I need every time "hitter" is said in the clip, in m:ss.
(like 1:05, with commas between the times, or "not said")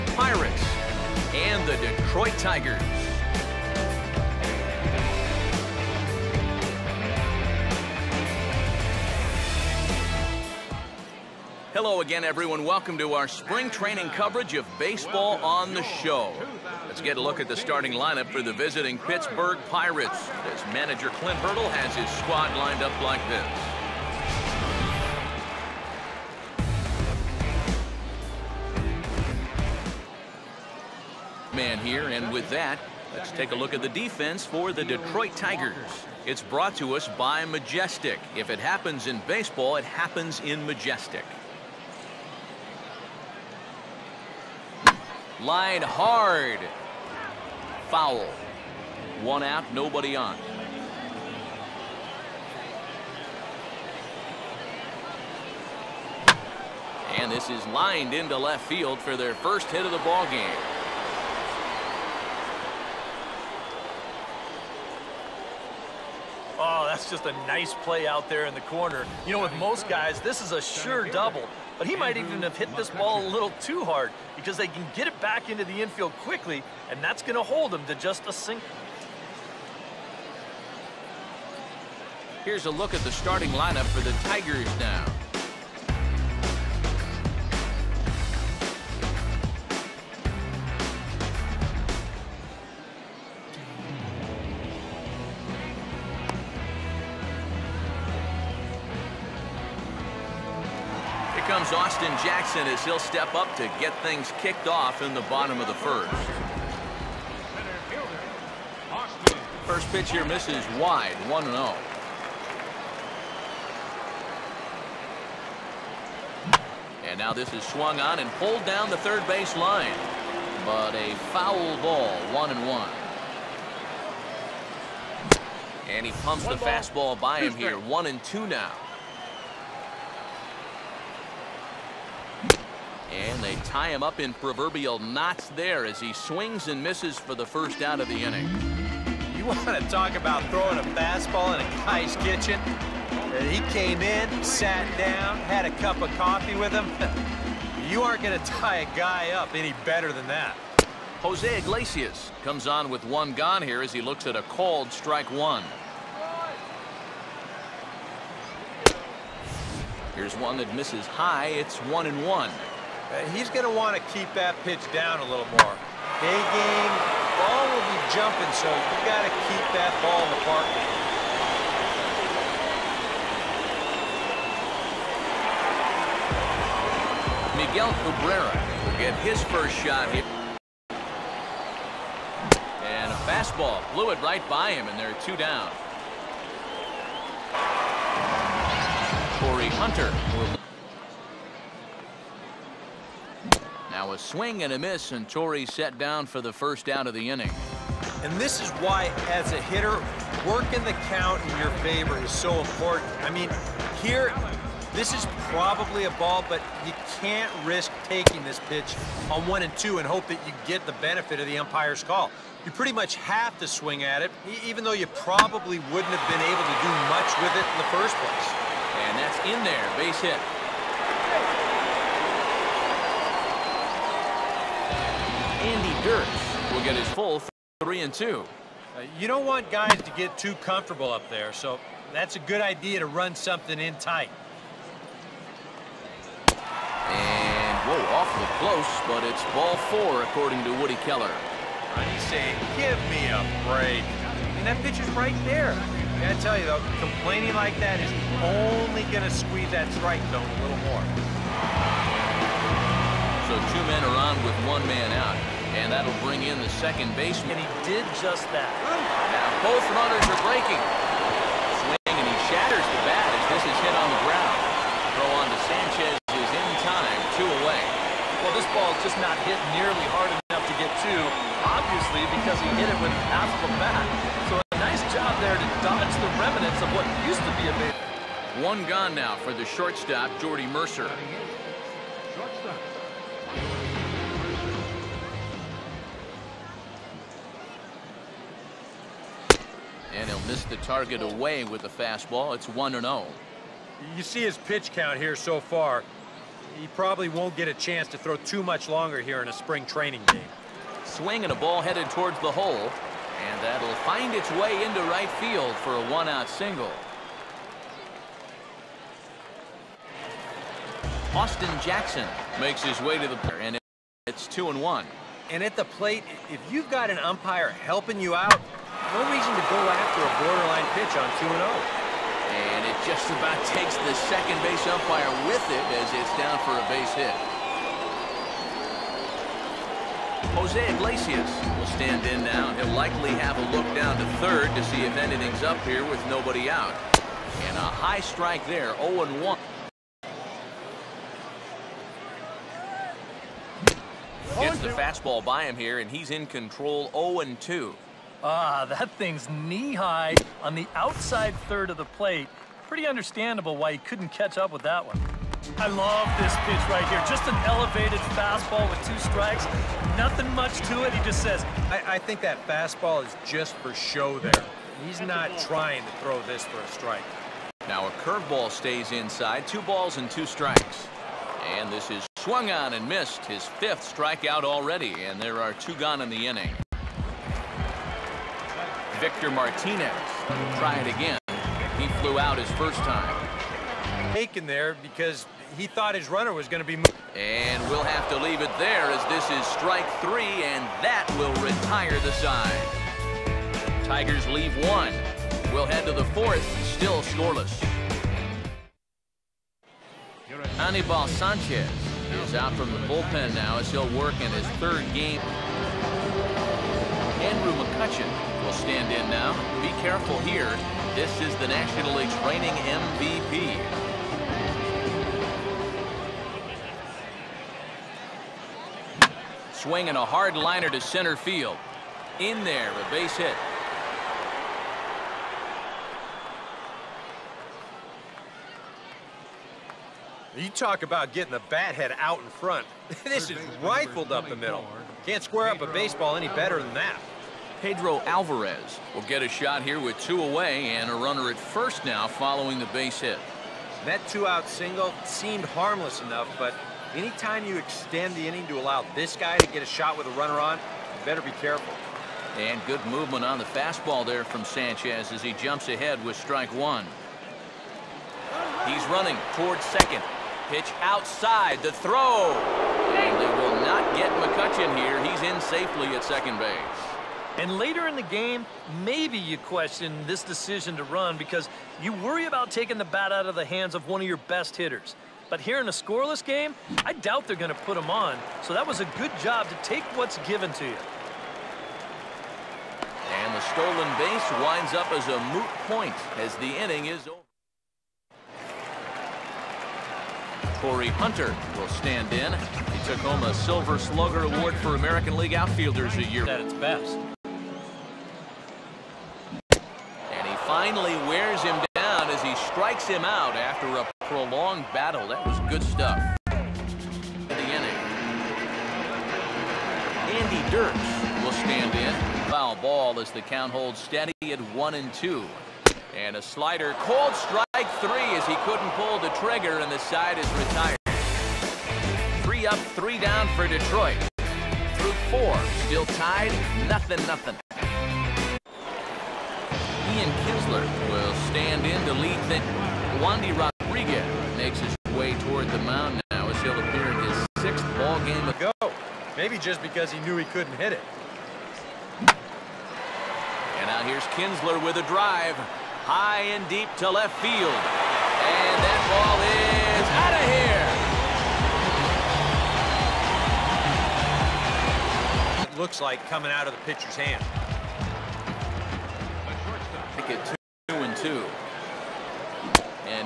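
3:19, 7:54.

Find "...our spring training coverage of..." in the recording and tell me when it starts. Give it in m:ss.
0:13.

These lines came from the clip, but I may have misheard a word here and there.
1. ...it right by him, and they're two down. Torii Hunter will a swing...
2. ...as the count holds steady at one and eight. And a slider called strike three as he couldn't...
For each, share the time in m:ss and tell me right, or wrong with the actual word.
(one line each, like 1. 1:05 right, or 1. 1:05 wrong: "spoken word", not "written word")
1. 3:04 right
2. 8:33 wrong: "two", not "eight".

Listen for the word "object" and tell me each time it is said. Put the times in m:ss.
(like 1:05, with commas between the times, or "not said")
not said.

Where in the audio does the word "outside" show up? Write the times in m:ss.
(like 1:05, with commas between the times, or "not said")
5:50, 7:40.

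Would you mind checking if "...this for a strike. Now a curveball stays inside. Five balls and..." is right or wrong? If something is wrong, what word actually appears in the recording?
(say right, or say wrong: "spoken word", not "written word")
wrong: "Two", not "Five".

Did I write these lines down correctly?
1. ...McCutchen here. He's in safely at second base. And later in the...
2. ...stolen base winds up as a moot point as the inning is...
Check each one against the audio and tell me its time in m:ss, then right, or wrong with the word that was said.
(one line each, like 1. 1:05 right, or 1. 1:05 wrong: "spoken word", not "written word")
1. 7:44 right
2. 8:03 right.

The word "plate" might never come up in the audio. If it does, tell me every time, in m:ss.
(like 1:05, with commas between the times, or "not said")
5:15, 5:52.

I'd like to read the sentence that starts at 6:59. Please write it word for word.
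Swinging a hard liner to center field.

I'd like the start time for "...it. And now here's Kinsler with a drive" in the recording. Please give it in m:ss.
9:00.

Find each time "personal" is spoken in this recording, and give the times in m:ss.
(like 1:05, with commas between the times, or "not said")
not said.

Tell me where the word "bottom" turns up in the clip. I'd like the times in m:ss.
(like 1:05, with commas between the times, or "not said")
1:45.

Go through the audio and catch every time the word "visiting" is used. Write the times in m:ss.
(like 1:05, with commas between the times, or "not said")
0:18.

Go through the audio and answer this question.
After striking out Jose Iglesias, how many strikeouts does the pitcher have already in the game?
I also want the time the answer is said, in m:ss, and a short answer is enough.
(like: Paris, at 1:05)
5, at 6:13.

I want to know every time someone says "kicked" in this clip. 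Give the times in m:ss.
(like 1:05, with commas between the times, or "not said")
1:44.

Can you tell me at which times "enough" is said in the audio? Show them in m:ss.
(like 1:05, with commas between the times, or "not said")
4:30, 7:26.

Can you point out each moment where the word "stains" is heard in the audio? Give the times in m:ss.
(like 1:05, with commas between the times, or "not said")
not said.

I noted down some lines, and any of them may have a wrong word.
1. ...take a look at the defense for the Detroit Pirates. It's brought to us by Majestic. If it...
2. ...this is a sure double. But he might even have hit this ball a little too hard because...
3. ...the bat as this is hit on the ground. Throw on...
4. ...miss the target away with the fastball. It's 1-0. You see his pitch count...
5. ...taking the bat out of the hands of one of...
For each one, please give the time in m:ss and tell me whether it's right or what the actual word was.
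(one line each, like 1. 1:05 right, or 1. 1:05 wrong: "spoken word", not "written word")
1. 0:33 wrong: "Tigers", not "Pirates"
2. 1:10 right
3. 4:22 right
4. 4:50 right
5. 7:52 right.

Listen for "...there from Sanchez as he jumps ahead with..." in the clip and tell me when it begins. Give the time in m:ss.
7:34.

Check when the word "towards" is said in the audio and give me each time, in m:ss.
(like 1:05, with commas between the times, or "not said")
5:02, 7:39, 8:55.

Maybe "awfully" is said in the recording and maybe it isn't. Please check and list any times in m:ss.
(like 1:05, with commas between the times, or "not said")
3:58.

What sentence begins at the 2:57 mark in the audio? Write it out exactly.
Miguel Cabrera will get his first shot here.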